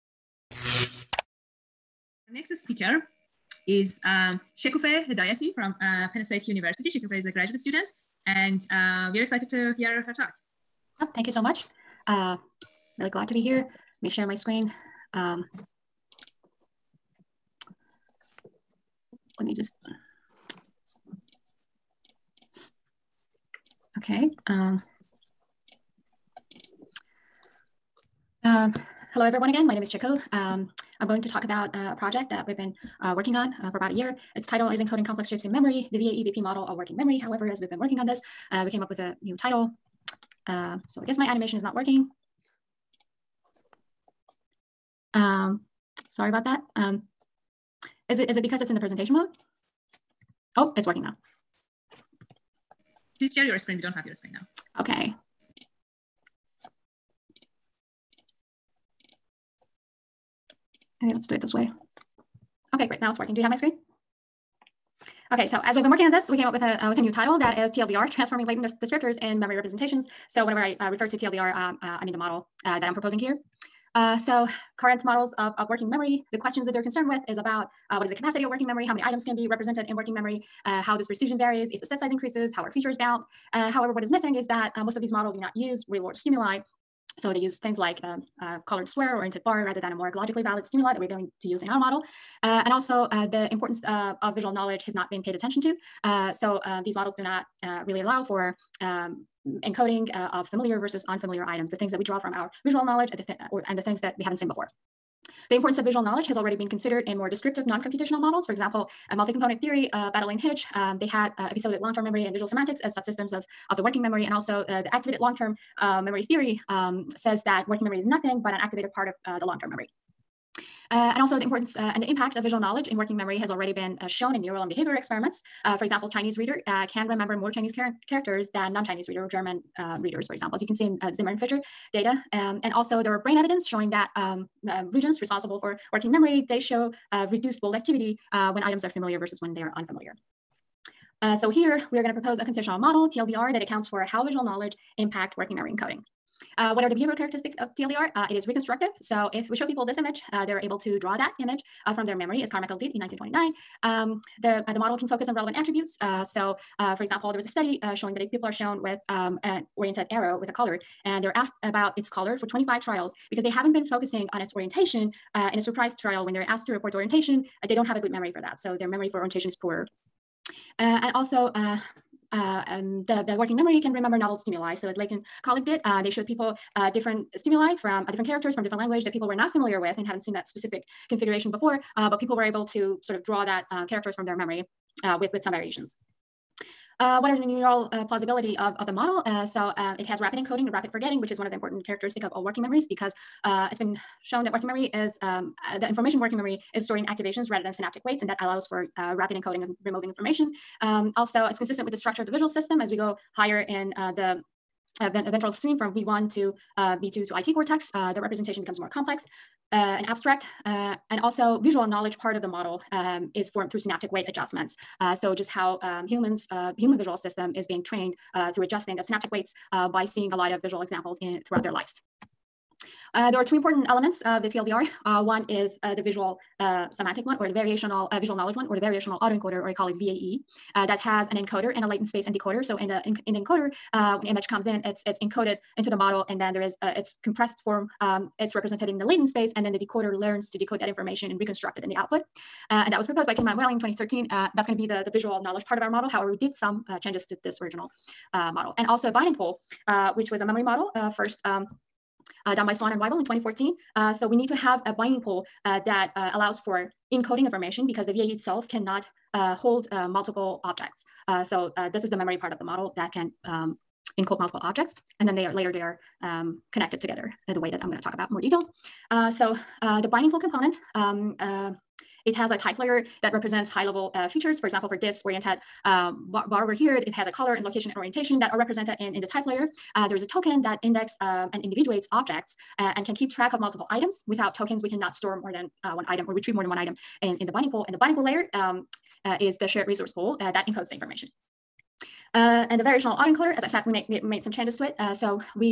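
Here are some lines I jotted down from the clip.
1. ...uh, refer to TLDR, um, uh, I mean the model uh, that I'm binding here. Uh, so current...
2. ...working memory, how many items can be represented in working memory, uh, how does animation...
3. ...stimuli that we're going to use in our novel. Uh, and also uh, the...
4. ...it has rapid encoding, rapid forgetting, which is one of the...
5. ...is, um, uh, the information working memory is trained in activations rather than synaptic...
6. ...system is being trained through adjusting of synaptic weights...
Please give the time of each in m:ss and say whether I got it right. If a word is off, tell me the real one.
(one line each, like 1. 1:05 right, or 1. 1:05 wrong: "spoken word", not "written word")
1. 1:10 wrong: "proposing", not "binding"
2. 1:18 wrong: "precision", not "animation"
3. 1:30 wrong: "model", not "novel"
4. 3:09 right
5. 3:14 wrong: "stored", not "trained"
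6. 3:37 right.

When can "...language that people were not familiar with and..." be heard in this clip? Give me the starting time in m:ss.
2:58.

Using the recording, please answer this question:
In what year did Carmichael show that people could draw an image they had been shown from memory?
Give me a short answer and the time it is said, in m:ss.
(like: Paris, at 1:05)
1929, at 2:32.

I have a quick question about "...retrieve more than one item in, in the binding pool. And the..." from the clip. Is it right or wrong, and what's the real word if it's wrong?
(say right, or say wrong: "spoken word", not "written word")
right.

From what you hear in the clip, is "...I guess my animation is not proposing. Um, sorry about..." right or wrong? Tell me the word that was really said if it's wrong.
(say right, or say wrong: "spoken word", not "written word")
wrong: "working", not "proposing".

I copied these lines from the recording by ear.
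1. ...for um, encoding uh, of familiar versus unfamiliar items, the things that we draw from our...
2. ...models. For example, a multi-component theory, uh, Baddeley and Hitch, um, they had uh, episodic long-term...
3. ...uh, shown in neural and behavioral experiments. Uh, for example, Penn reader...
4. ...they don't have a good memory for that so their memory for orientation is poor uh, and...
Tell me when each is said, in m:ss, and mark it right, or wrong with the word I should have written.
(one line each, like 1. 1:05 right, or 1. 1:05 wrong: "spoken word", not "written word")
1. 1:38 right
2. 1:48 right
3. 2:04 wrong: "Chinese", not "Penn"
4. 2:47 right.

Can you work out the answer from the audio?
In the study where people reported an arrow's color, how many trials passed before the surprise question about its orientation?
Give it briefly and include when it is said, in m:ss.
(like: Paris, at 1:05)
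25, at 2:42.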